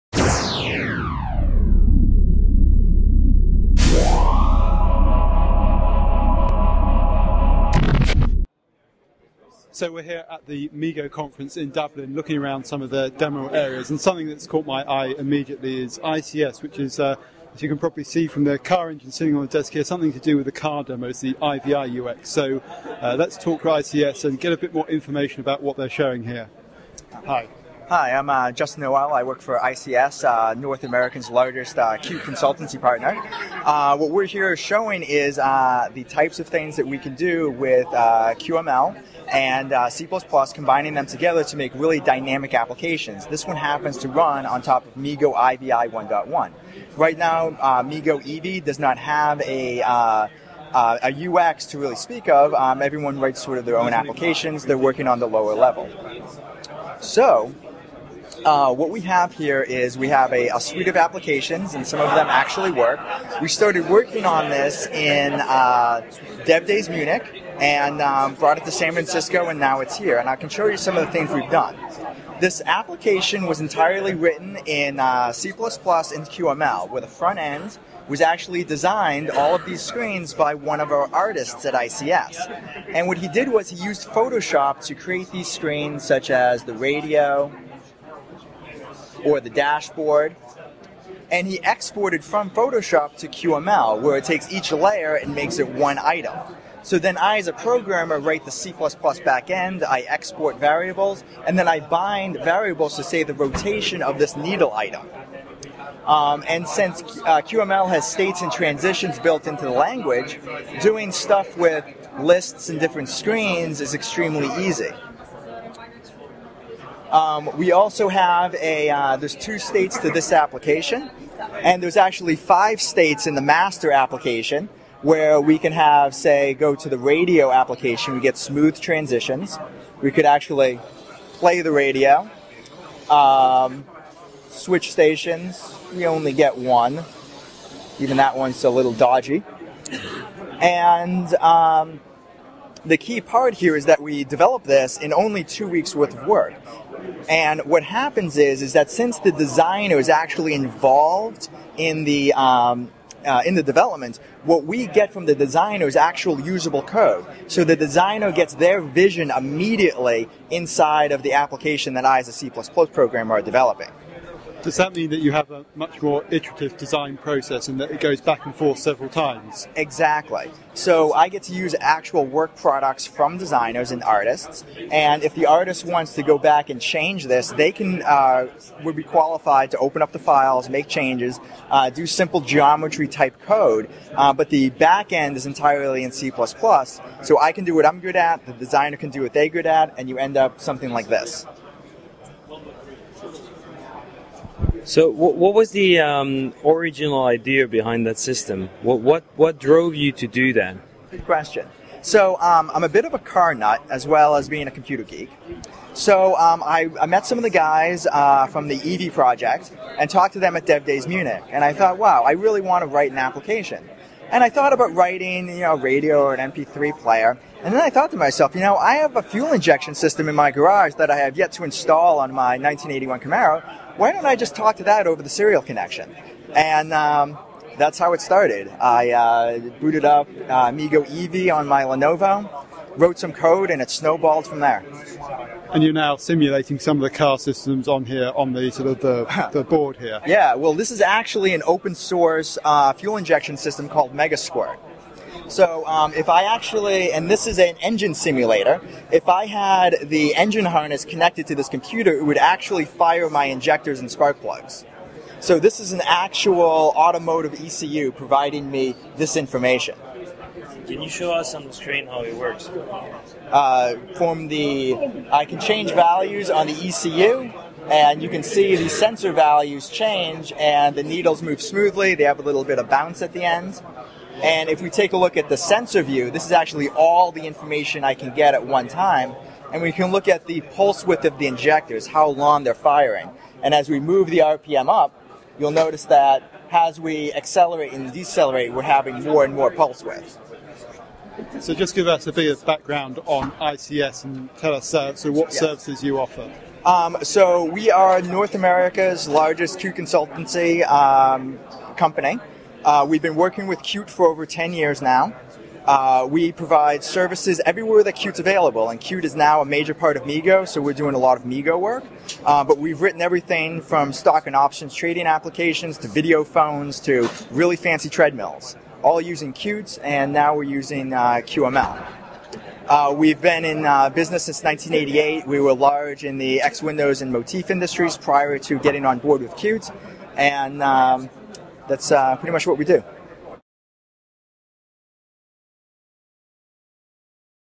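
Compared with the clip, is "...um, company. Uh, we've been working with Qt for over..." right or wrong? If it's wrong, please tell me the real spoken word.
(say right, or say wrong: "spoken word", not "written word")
right.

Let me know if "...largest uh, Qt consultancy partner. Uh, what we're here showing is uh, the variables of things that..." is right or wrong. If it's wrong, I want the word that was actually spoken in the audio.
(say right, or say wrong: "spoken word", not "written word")
wrong: "types", not "variables".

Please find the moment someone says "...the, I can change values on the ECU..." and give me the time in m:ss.
4:24.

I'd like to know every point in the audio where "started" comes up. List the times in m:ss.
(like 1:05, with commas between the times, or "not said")
1:03, 3:48.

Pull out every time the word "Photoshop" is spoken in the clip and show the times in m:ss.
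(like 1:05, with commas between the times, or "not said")
1:24, 1:32.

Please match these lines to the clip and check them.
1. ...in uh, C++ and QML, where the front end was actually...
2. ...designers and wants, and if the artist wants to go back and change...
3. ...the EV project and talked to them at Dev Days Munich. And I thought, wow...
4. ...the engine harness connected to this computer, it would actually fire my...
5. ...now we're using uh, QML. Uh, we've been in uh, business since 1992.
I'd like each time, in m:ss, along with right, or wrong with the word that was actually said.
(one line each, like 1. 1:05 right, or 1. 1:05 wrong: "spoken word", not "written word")
1. 1:14 right
2. 2:53 wrong: "artists", not "wants"
3. 3:28 right
4. 4:10 right
5. 5:20 wrong: "1988", not "1992".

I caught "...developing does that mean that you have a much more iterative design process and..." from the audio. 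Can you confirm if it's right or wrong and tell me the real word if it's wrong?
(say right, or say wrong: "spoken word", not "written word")
right.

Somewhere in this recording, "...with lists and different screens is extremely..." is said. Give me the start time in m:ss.
1:51.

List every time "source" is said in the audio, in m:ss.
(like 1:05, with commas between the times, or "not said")
4:01.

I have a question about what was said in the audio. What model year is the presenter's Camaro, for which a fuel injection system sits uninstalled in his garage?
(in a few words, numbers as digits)
1981.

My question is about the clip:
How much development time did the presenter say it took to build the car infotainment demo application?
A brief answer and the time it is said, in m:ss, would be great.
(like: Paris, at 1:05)
2 weeks, at 2:25.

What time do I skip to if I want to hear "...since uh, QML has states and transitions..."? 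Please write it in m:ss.
1:46.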